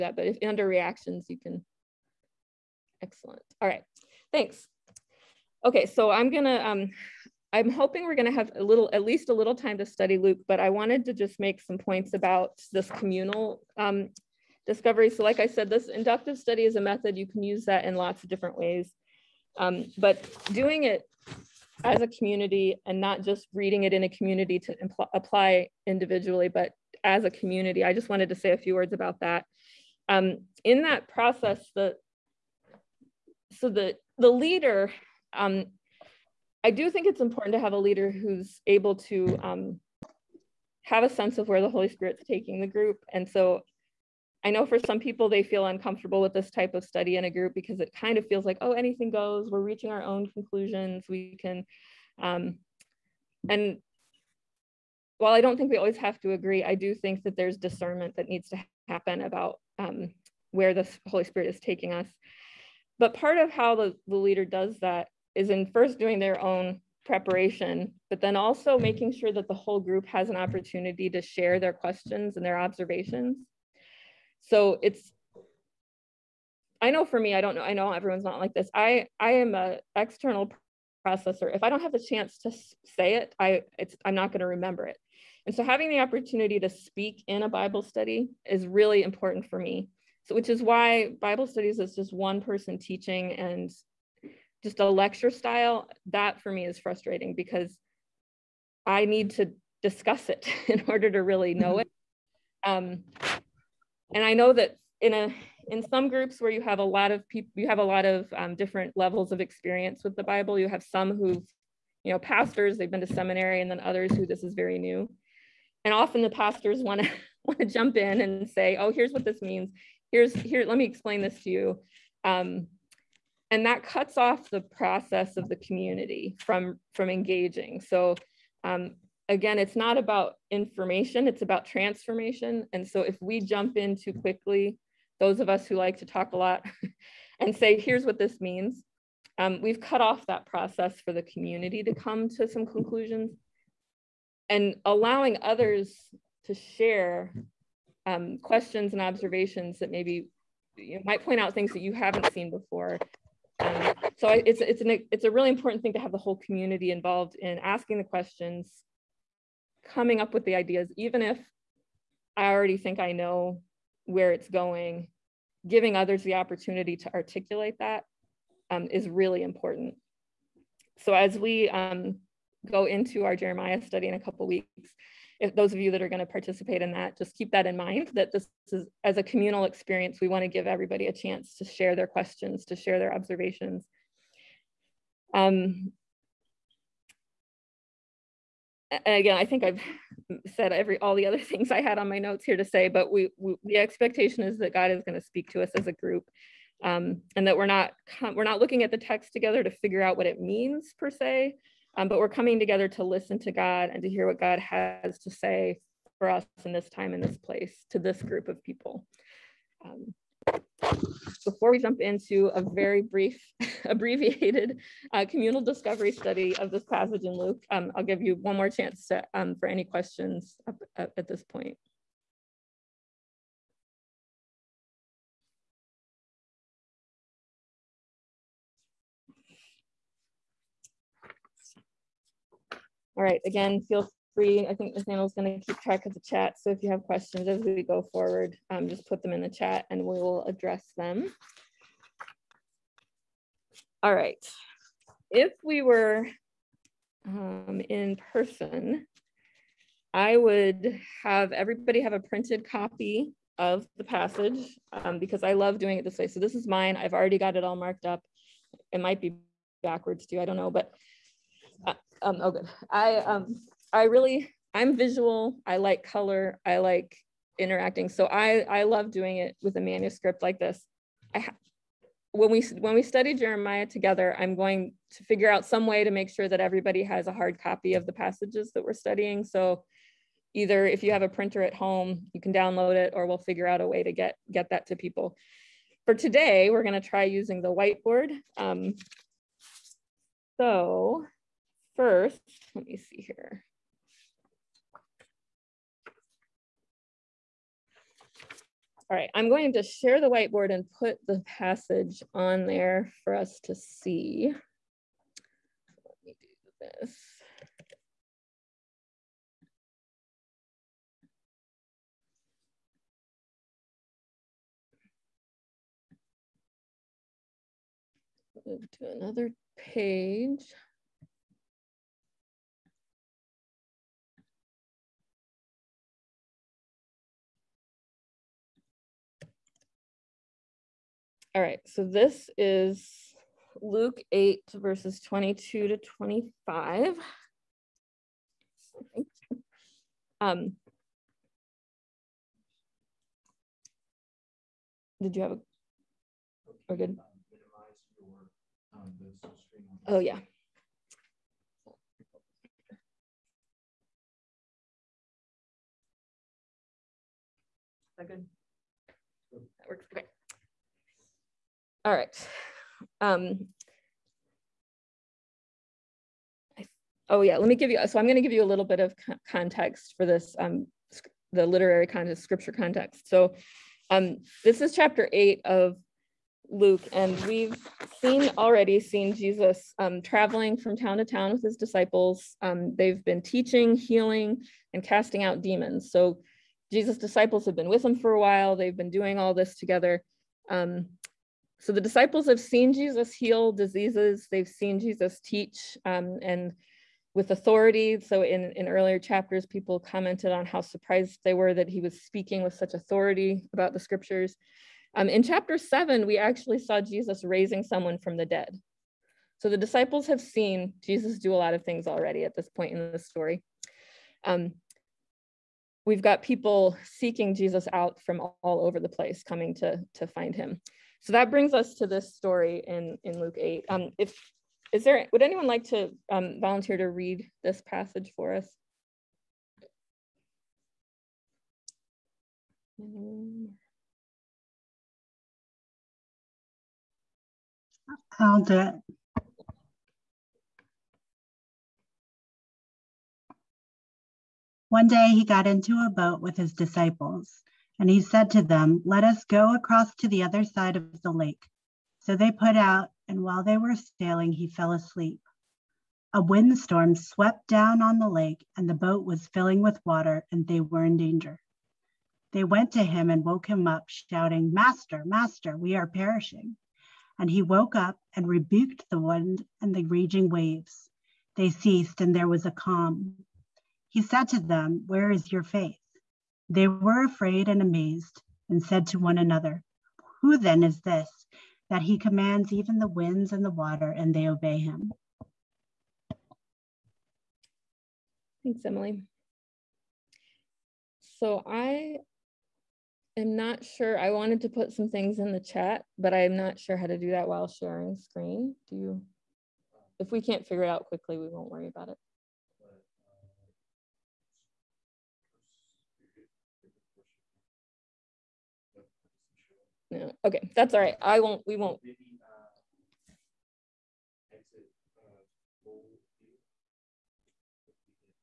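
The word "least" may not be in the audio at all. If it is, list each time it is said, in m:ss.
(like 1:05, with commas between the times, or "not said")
0:09.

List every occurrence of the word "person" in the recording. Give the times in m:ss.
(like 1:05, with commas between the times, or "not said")
1:32, 4:08.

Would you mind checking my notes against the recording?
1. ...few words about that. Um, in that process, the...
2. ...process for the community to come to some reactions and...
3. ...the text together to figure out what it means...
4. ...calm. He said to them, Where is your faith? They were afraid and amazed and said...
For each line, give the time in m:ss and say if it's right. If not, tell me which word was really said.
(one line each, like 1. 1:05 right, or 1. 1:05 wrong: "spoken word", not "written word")
1. 0:28 right
2. 2:20 wrong: "conclusions", not "reactions"
3. 3:18 right
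4. 7:52 right.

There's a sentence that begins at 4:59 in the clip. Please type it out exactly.
All right, I'm going to share the whiteboard and put the passage on there for us to see.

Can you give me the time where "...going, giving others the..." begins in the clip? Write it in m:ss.
2:44.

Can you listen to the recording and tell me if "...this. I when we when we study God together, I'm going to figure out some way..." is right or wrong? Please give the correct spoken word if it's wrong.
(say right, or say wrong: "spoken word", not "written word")
wrong: "Jeremiah", not "God".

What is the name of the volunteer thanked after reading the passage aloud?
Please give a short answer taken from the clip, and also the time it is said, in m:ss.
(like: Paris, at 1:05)
Emily, at 8:08.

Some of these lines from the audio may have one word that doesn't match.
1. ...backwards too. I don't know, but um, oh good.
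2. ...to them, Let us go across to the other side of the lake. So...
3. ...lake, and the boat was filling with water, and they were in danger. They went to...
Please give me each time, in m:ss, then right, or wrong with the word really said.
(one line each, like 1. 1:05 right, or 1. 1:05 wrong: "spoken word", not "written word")
1. 4:19 right
2. 7:28 right
3. 7:38 right.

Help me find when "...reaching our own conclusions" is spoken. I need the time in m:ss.
0:49.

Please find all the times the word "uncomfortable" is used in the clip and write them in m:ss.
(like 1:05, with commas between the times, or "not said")
0:45.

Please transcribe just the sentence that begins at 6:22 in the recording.
Um, they've been teaching, healing, and casting out demons.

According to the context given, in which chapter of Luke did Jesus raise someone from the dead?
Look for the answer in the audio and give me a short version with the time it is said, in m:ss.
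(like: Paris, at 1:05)
chapter 7, at 6:45.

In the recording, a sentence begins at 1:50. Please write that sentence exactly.
You have some who've, you know, pastors they've been to seminary, and then others who this is very new.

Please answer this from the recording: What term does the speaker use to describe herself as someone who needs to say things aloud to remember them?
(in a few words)
external processor.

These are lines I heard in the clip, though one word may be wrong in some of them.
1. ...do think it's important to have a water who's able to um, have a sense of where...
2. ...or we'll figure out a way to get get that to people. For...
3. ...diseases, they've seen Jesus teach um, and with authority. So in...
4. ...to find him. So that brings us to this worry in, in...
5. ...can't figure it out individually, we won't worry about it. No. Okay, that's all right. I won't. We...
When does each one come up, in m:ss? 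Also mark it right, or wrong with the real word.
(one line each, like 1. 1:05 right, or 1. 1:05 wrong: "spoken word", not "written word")
1. 0:36 wrong: "leader", not "water"
2. 4:43 right
3. 6:33 right
4. 7:00 wrong: "story", not "worry"
5. 8:20 wrong: "quickly", not "individually".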